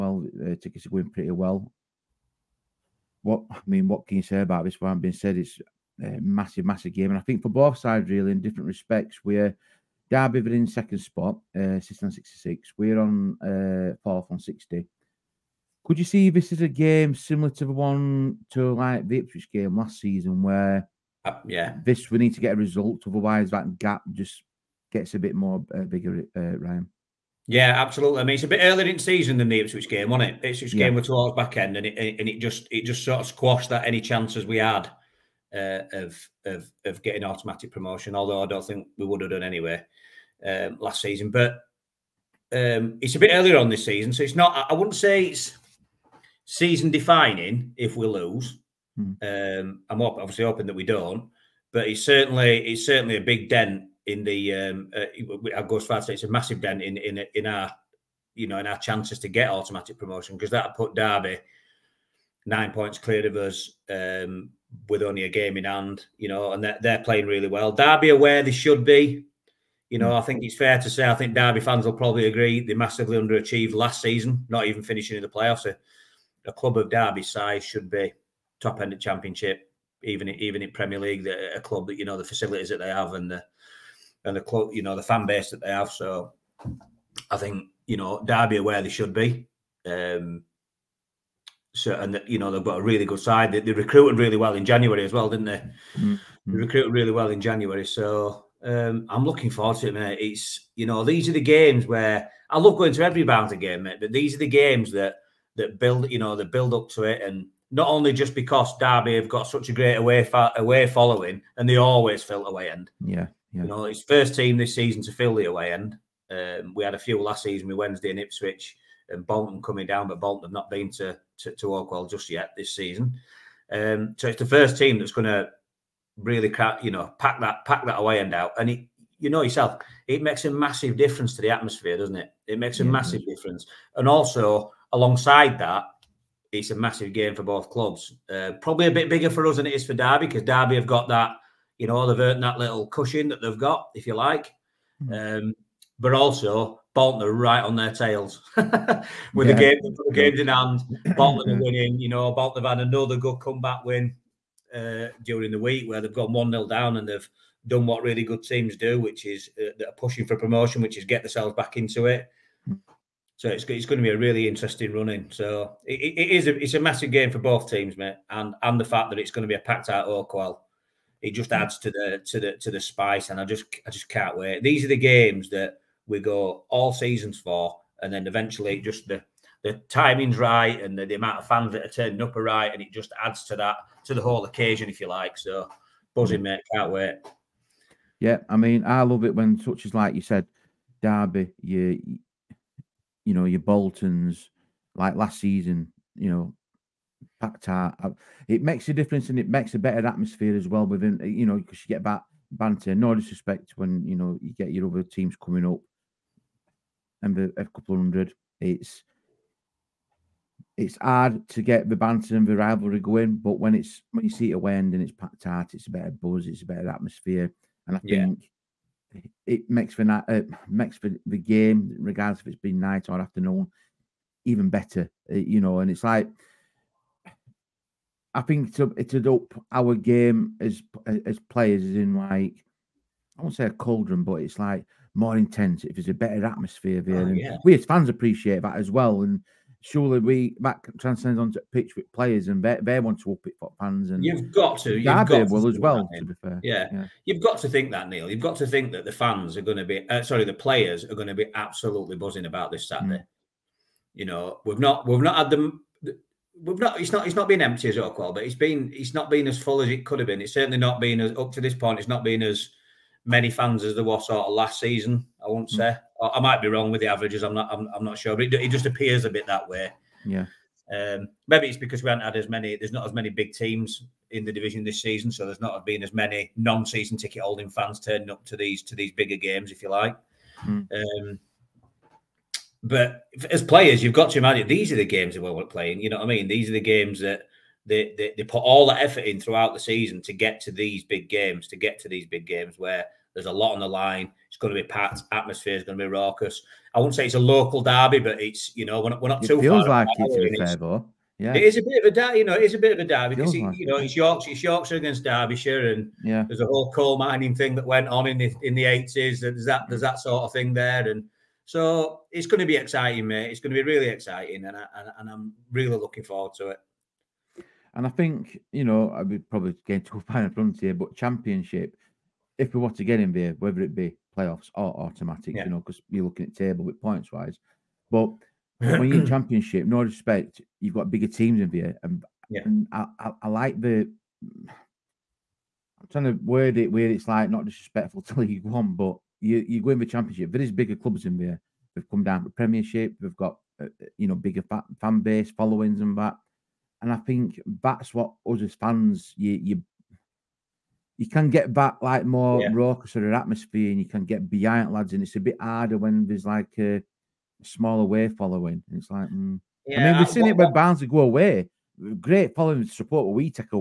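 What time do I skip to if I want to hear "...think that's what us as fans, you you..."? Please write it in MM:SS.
05:47.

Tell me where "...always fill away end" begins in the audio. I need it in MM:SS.
01:51.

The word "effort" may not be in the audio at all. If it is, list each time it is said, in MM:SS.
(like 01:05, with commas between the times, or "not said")
04:48.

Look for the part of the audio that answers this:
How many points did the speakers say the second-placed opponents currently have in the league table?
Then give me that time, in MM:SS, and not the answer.
00:11.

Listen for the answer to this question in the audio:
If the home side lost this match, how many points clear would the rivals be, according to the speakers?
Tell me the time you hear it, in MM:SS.
01:02.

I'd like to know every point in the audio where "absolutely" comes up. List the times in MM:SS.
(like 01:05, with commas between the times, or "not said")
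00:27, 04:11.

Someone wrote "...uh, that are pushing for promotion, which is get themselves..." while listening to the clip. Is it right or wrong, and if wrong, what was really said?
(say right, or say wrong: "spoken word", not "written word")
right.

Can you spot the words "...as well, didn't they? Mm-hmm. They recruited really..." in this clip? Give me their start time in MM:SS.
01:35.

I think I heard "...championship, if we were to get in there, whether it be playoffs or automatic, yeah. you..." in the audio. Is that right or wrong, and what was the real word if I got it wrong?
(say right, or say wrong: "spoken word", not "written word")
right.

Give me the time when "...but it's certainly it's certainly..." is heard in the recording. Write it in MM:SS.
00:51.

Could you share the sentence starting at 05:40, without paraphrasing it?
There is bigger clubs in there.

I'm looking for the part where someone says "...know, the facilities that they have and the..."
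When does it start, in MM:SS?
01:22.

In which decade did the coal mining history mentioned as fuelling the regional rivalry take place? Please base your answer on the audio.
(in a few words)
The eighties.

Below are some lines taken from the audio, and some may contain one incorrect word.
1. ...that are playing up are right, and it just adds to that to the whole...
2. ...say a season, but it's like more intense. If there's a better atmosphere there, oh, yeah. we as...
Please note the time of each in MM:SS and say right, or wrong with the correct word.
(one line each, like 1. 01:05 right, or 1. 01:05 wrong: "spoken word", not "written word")
1. 03:01 wrong: "turning", not "playing"
2. 03:53 wrong: "cauldron", not "season".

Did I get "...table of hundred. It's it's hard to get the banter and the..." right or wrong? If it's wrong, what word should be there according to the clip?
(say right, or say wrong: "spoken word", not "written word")
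wrong: "couple", not "table".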